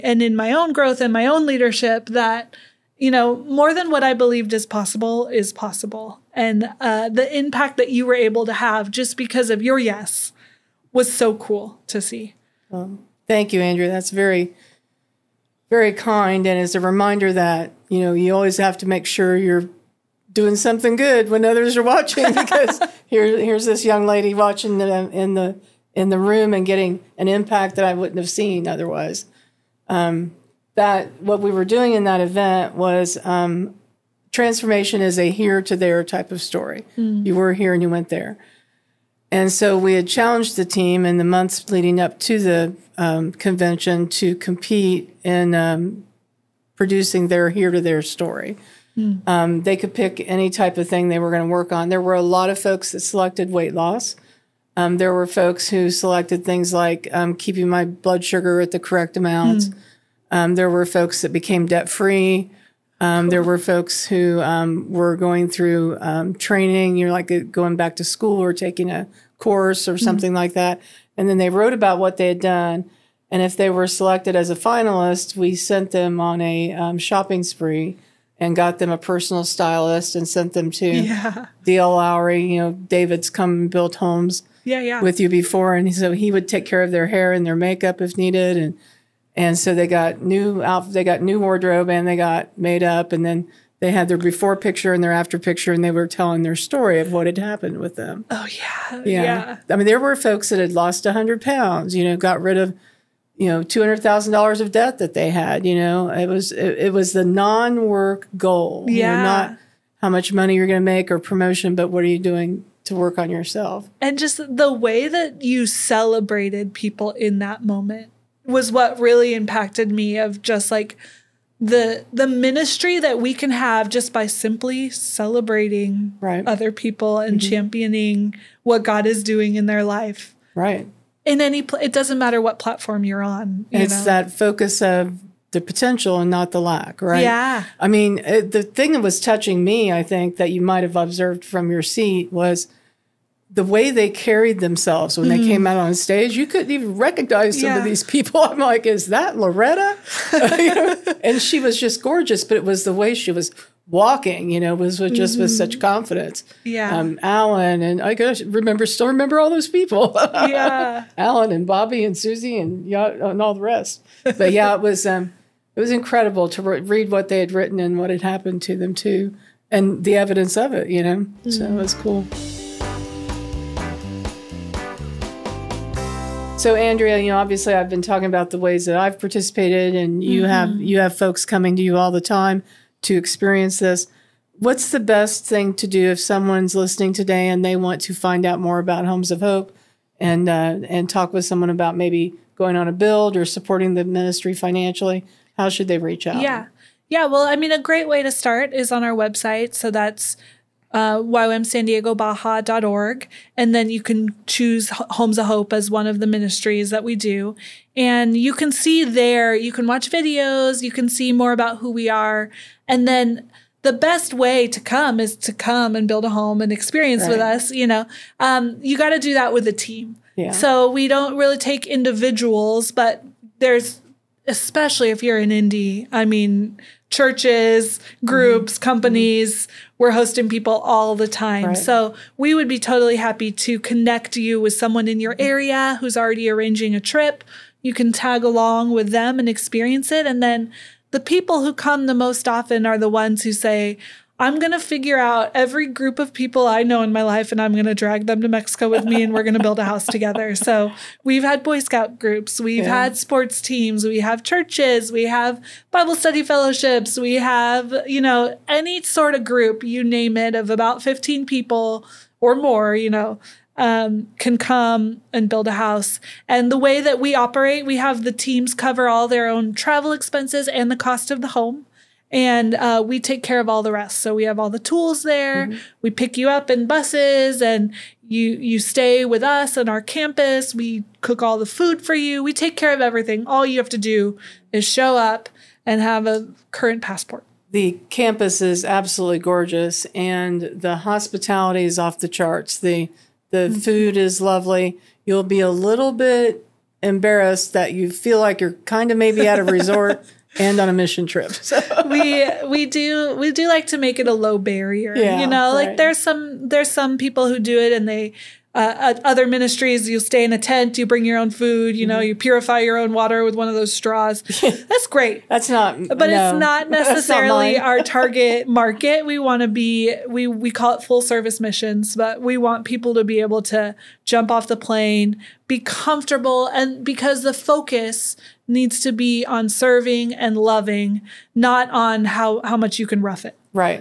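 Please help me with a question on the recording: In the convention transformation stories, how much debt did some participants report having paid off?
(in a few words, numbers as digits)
$200,000.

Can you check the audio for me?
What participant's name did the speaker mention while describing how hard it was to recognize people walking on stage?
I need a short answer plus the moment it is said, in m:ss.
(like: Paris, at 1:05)
Loretta, at 2:29.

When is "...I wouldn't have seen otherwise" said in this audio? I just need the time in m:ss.
0:27.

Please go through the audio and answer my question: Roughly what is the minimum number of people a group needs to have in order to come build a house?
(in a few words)
15.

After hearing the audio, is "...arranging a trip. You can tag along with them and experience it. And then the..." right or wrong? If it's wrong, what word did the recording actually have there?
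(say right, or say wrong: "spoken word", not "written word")
right.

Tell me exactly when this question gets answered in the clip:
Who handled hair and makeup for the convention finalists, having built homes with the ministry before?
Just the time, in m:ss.
1:21.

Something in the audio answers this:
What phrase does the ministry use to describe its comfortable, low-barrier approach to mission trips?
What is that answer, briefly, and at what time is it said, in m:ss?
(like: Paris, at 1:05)
full service missions, at 5:21.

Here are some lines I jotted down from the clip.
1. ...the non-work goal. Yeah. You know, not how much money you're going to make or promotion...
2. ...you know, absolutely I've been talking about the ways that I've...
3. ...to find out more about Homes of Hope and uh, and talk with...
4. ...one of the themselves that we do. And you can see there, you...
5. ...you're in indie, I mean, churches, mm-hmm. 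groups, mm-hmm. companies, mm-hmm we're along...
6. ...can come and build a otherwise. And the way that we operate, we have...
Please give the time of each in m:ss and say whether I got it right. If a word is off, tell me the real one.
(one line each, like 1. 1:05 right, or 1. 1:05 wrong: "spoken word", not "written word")
1. 1:47 right
2. 2:57 wrong: "obviously", not "absolutely"
3. 3:08 right
4. 3:25 wrong: "ministries", not "themselves"
5. 3:45 wrong: "hosting", not "along"
6. 4:24 wrong: "house", not "otherwise".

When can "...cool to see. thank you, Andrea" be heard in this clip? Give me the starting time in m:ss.
0:11.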